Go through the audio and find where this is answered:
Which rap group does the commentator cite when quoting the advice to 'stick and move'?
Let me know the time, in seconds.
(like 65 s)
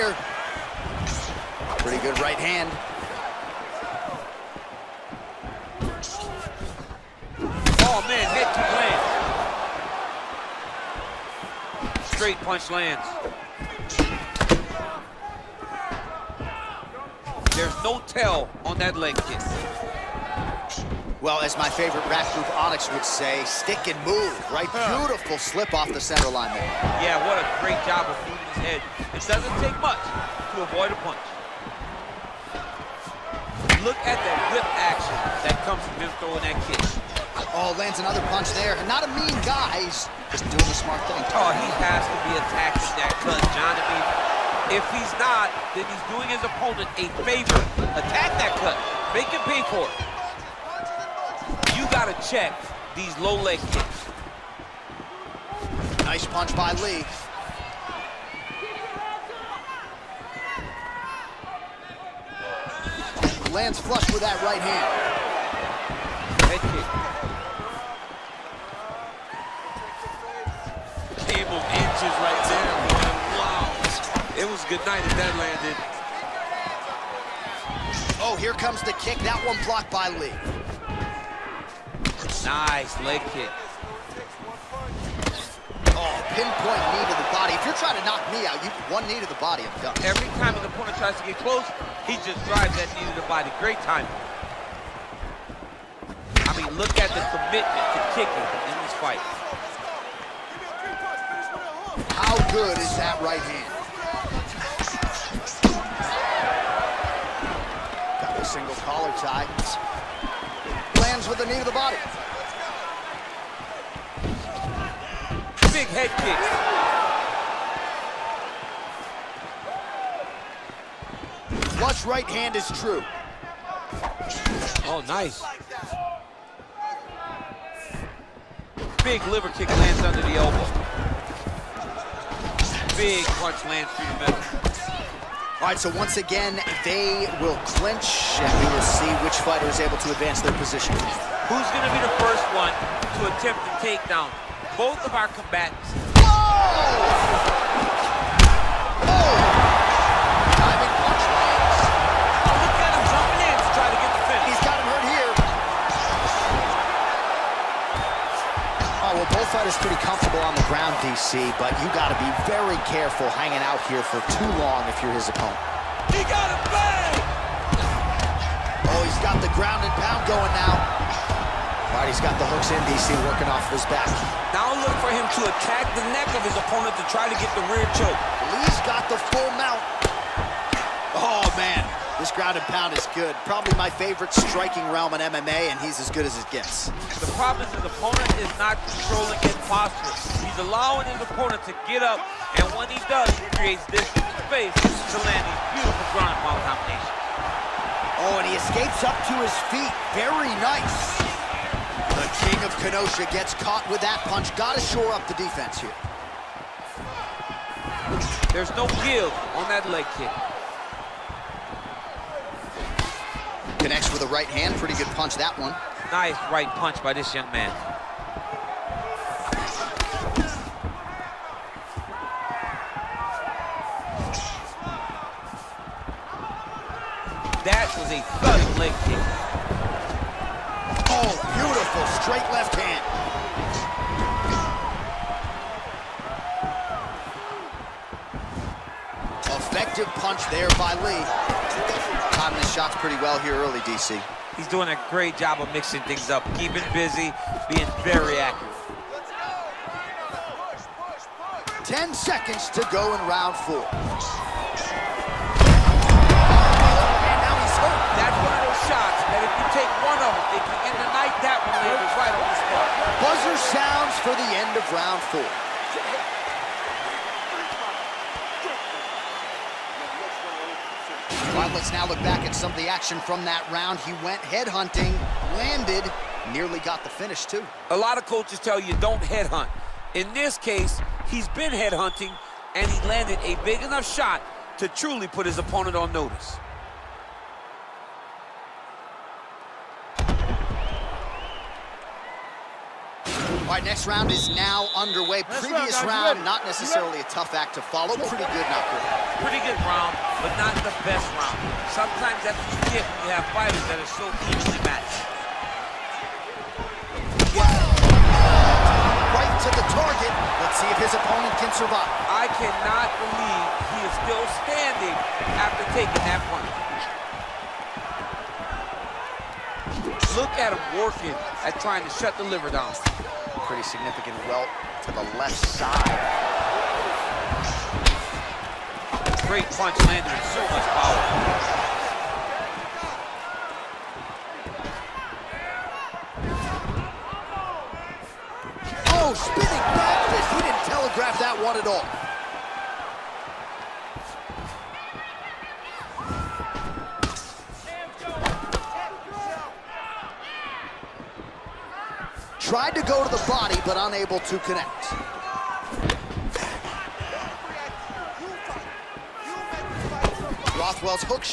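22 s.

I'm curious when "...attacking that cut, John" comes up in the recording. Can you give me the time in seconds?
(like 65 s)
42 s.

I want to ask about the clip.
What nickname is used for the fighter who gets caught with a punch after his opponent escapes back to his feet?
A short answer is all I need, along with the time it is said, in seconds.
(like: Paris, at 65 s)
The king of Kenosha, at 202 s.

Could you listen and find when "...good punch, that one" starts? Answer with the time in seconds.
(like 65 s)
214 s.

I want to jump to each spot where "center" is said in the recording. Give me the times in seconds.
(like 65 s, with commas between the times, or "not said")
25 s.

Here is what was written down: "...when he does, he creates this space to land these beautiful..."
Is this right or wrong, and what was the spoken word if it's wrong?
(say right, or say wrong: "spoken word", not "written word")
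right.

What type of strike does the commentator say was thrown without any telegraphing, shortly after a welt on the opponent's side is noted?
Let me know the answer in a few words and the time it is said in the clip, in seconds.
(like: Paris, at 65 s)
Spinning back fist, at 339 s.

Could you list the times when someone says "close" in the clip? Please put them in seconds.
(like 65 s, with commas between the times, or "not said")
91 s.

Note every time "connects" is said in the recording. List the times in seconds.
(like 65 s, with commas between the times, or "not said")
213 s, 354 s.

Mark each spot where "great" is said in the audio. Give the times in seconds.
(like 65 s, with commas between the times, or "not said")
27 s, 93 s, 245 s, 329 s.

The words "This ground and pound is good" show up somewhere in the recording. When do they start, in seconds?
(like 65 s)
182 s.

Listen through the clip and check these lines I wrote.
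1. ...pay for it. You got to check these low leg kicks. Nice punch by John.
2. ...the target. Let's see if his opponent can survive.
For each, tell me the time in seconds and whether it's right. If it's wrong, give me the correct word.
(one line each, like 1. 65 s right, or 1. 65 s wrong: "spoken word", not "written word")
1. 49 s wrong: "Lee", not "John"
2. 309 s right.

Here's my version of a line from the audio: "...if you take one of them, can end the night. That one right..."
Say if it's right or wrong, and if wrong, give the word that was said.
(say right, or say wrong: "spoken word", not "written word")
right.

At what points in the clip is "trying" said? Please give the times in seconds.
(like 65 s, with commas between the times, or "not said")
87 s, 321 s.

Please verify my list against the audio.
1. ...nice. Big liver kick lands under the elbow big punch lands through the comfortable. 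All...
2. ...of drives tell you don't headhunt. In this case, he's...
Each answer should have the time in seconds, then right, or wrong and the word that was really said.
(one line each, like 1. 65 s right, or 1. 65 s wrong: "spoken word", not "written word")
1. 125 s wrong: "middle", not "comfortable"
2. 278 s wrong: "coaches", not "drives".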